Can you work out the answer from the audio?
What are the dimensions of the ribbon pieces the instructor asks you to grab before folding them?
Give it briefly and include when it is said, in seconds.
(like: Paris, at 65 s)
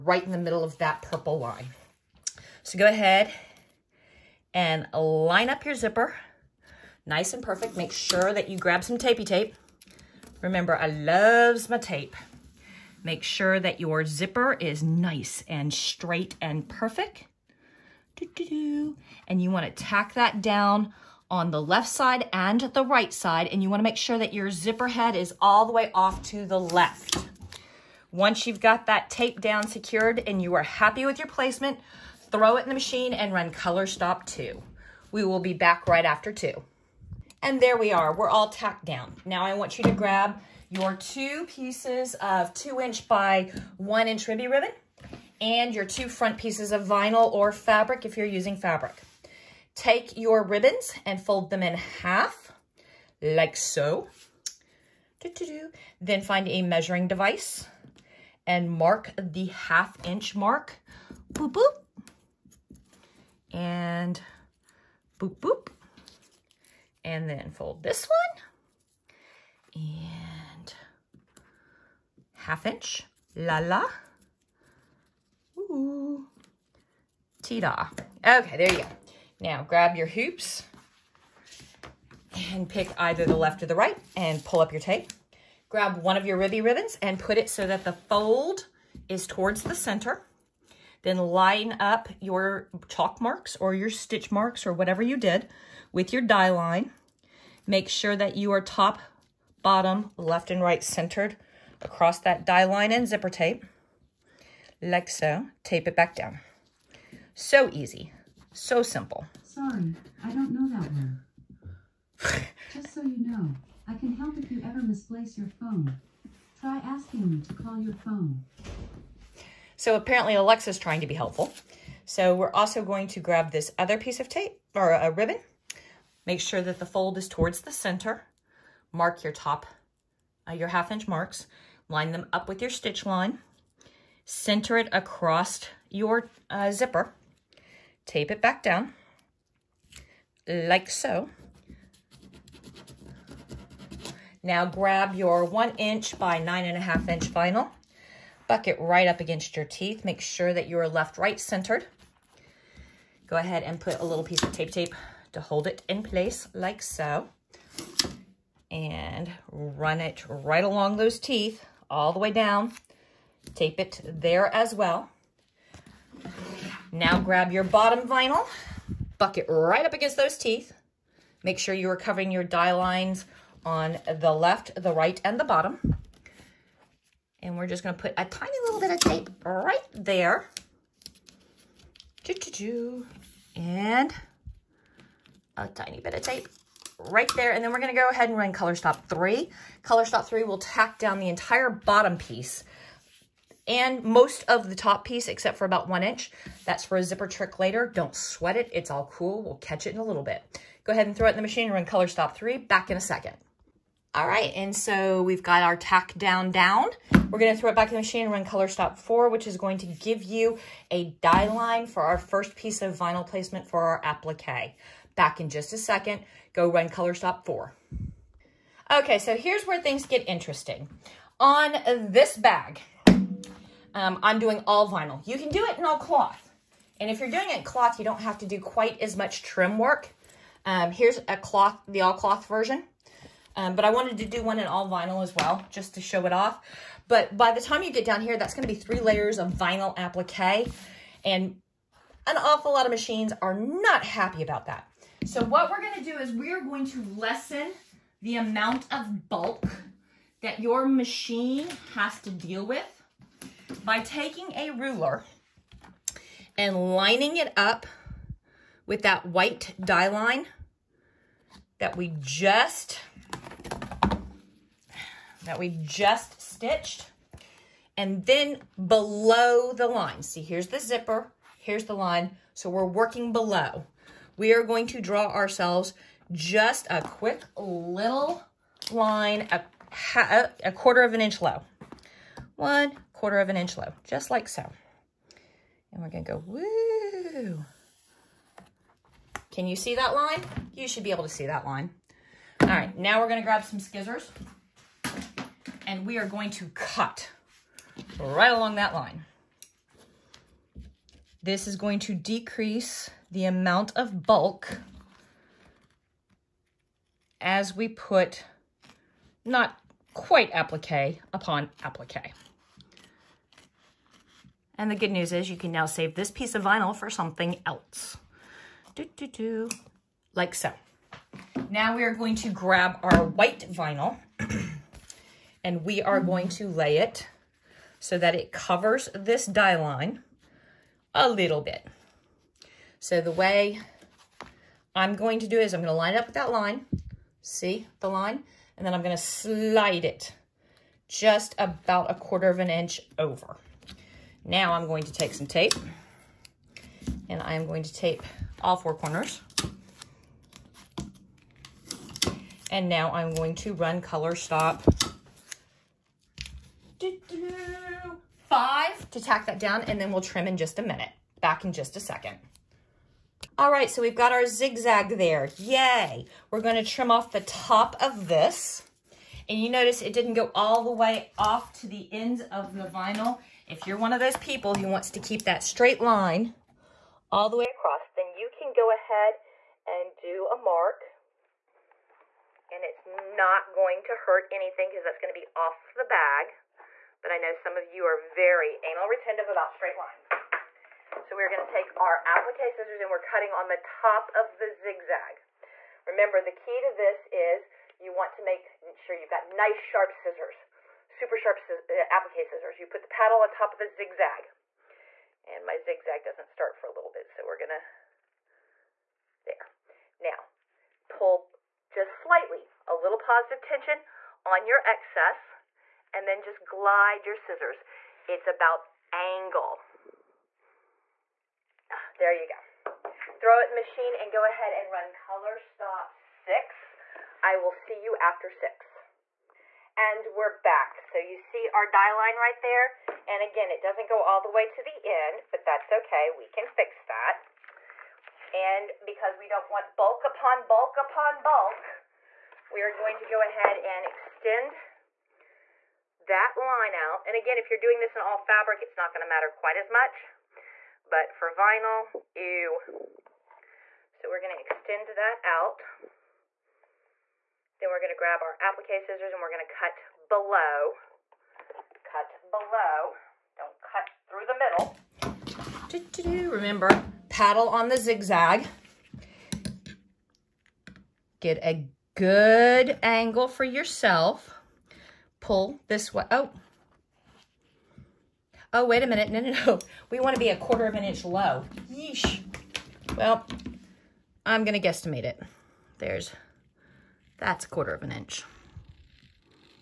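2 inch by 1 inch, at 42 s.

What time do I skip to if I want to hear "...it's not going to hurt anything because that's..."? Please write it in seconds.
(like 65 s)
382 s.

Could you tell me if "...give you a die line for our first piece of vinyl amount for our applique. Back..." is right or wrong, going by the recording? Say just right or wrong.
wrong.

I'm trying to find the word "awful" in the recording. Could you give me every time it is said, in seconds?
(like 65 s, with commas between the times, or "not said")
242 s.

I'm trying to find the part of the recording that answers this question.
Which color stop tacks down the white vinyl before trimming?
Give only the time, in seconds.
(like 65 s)
354 s.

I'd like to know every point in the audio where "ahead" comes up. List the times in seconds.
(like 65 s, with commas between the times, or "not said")
2 s, 153 s, 188 s, 200 s, 378 s, 424 s, 443 s.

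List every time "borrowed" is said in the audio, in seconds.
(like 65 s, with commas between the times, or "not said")
not said.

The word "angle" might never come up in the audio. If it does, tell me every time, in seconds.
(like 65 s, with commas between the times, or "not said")
419 s, 473 s.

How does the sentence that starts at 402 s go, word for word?
You put the paddle on top of the zigzag.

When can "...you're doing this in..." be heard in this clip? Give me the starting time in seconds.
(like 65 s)
447 s.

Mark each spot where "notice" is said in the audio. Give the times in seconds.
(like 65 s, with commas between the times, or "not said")
369 s.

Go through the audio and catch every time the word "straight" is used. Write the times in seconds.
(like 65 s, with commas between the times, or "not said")
15 s, 375 s, 389 s.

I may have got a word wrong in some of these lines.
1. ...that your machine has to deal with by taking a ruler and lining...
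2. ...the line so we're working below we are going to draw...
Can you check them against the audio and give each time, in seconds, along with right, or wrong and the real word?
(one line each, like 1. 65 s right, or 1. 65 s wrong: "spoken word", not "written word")
1. 250 s right
2. 271 s right.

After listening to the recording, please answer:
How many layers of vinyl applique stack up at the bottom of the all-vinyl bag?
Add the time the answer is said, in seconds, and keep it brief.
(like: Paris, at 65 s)
3, at 238 s.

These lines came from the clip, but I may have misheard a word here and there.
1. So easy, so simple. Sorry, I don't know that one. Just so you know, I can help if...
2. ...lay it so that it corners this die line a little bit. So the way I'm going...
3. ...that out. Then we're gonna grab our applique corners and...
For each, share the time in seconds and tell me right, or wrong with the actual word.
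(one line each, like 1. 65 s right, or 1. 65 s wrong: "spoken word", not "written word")
1. 107 s right
2. 326 s wrong: "covers", not "corners"
3. 455 s wrong: "scissors", not "corners".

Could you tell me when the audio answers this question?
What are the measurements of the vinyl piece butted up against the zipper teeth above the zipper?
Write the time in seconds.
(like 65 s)
145 s.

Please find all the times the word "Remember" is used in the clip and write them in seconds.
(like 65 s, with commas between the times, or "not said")
10 s, 396 s, 466 s.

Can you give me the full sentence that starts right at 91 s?
Then line up your chalk marks or your stitch marks or whatever you did with your die line.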